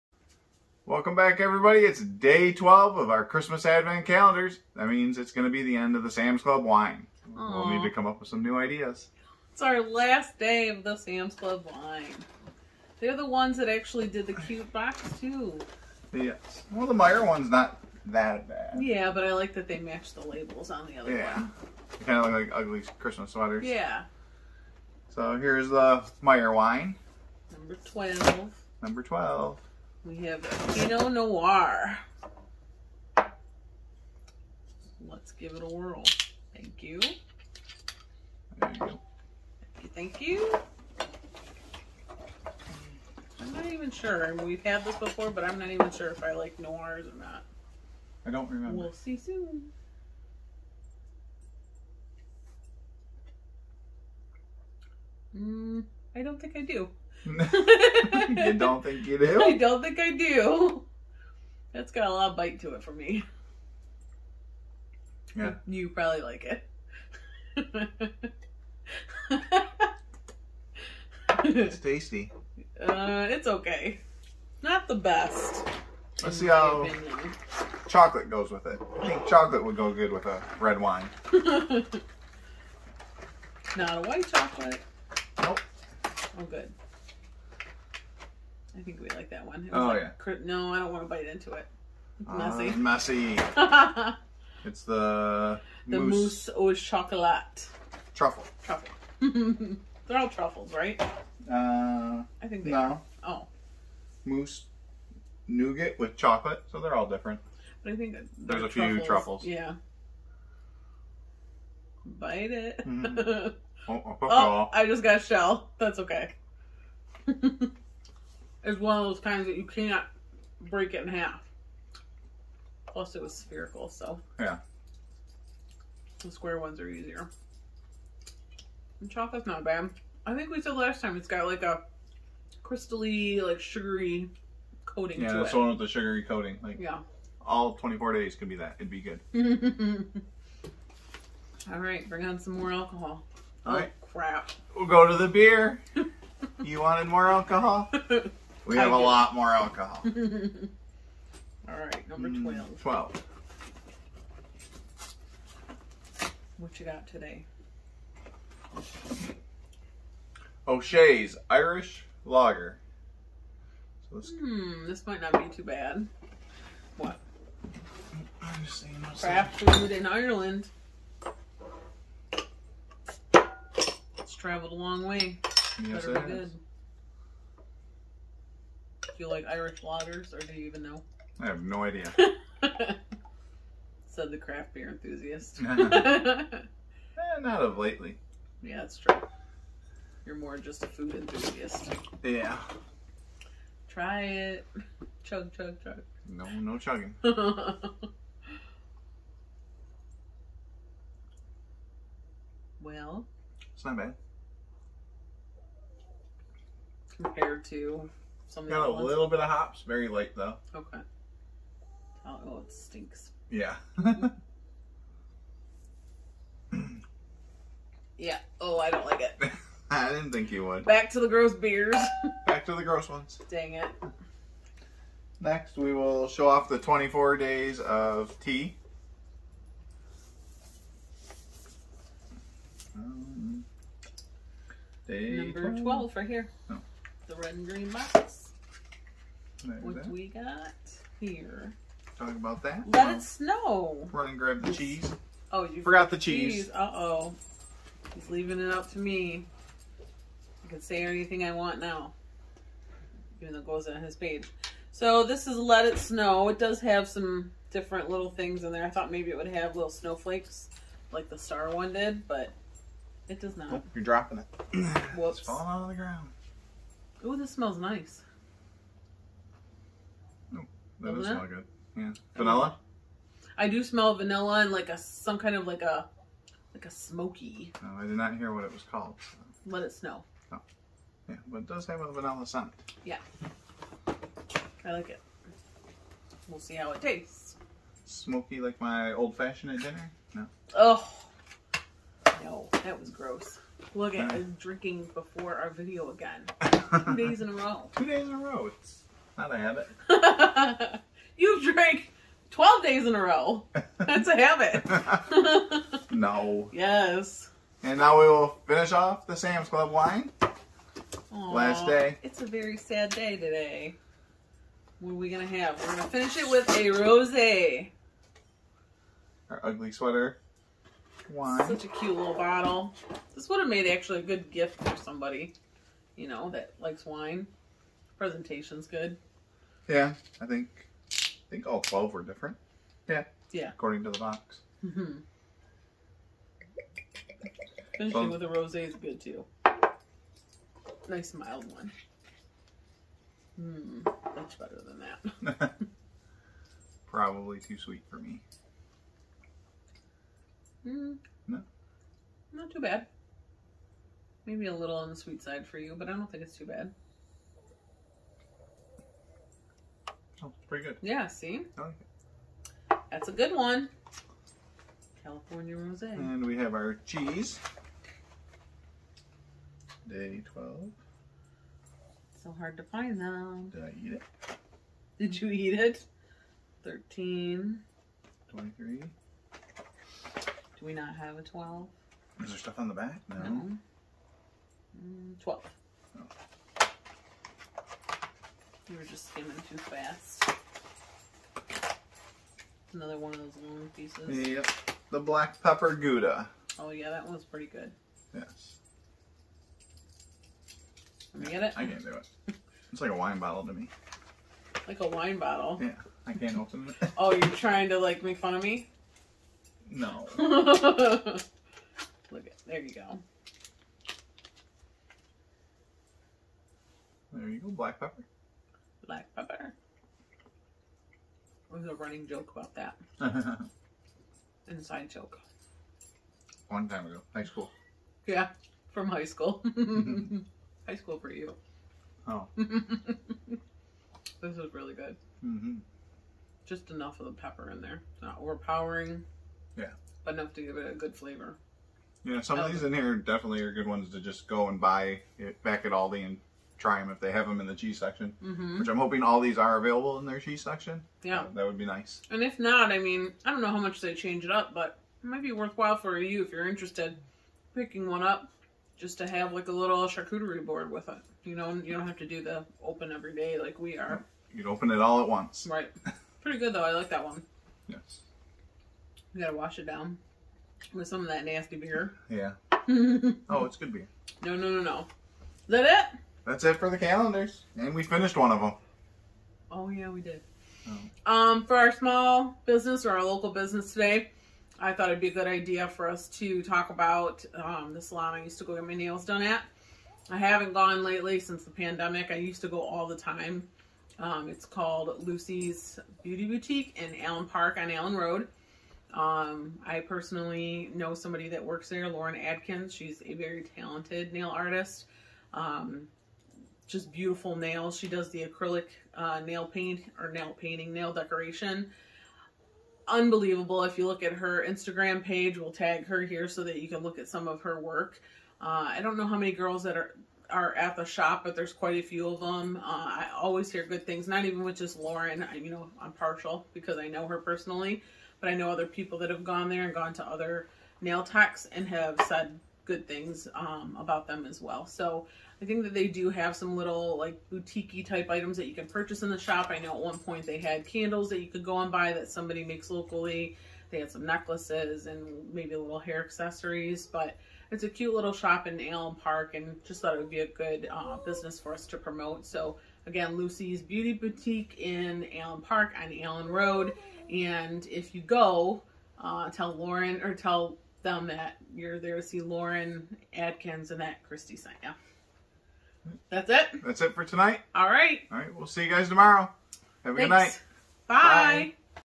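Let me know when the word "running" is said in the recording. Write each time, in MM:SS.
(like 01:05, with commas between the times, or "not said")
07:02.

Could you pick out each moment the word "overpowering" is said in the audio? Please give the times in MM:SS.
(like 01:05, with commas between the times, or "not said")
07:18.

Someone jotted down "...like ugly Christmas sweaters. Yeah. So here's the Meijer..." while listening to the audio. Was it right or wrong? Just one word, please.
right.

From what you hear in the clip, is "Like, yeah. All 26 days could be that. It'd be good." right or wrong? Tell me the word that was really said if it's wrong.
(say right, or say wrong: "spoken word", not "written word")
wrong: "24", not "26".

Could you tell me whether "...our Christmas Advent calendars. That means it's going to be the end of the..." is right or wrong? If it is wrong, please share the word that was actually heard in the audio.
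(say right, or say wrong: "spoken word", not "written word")
right.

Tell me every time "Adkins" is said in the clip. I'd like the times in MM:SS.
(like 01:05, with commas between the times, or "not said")
08:22, 09:23.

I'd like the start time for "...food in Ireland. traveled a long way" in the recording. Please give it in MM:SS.
02:49.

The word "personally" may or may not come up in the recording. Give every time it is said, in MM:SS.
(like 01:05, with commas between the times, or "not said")
08:19, 08:47.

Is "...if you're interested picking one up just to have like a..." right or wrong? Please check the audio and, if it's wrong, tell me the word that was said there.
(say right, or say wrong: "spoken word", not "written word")
right.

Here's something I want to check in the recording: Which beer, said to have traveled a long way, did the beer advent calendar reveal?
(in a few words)
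O'Shea's Irish Lager.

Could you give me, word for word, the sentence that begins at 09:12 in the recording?
So again, Lucy's Beauty Boutique in Allen Park on Allen Road.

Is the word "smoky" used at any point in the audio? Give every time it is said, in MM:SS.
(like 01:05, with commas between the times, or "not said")
04:36, 04:48.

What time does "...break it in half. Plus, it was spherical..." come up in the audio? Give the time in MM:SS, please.
02:00.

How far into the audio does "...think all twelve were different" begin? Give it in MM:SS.
05:31.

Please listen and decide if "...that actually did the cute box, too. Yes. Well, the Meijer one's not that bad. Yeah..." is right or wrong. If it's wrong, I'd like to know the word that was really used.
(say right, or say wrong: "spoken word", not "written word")
right.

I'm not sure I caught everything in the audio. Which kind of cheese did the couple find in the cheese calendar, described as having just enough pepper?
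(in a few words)
black pepper gouda.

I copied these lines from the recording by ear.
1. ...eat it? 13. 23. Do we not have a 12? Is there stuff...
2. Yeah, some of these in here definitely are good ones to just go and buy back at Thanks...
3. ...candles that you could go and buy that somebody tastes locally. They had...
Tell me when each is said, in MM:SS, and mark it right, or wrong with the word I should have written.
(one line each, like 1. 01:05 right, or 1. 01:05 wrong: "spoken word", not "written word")
1. 06:15 right
2. 07:22 wrong: "Aldi", not "Thanks"
3. 09:00 wrong: "makes", not "tastes".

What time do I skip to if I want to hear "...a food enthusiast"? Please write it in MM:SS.
03:10.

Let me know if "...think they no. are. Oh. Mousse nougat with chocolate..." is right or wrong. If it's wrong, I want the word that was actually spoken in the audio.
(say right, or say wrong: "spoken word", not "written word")
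right.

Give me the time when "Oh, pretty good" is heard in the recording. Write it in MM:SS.
06:00.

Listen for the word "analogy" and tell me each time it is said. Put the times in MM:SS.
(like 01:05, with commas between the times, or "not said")
not said.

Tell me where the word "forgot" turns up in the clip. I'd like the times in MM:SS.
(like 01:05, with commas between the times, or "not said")
04:05.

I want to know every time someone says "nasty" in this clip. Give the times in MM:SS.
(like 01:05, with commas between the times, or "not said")
07:51.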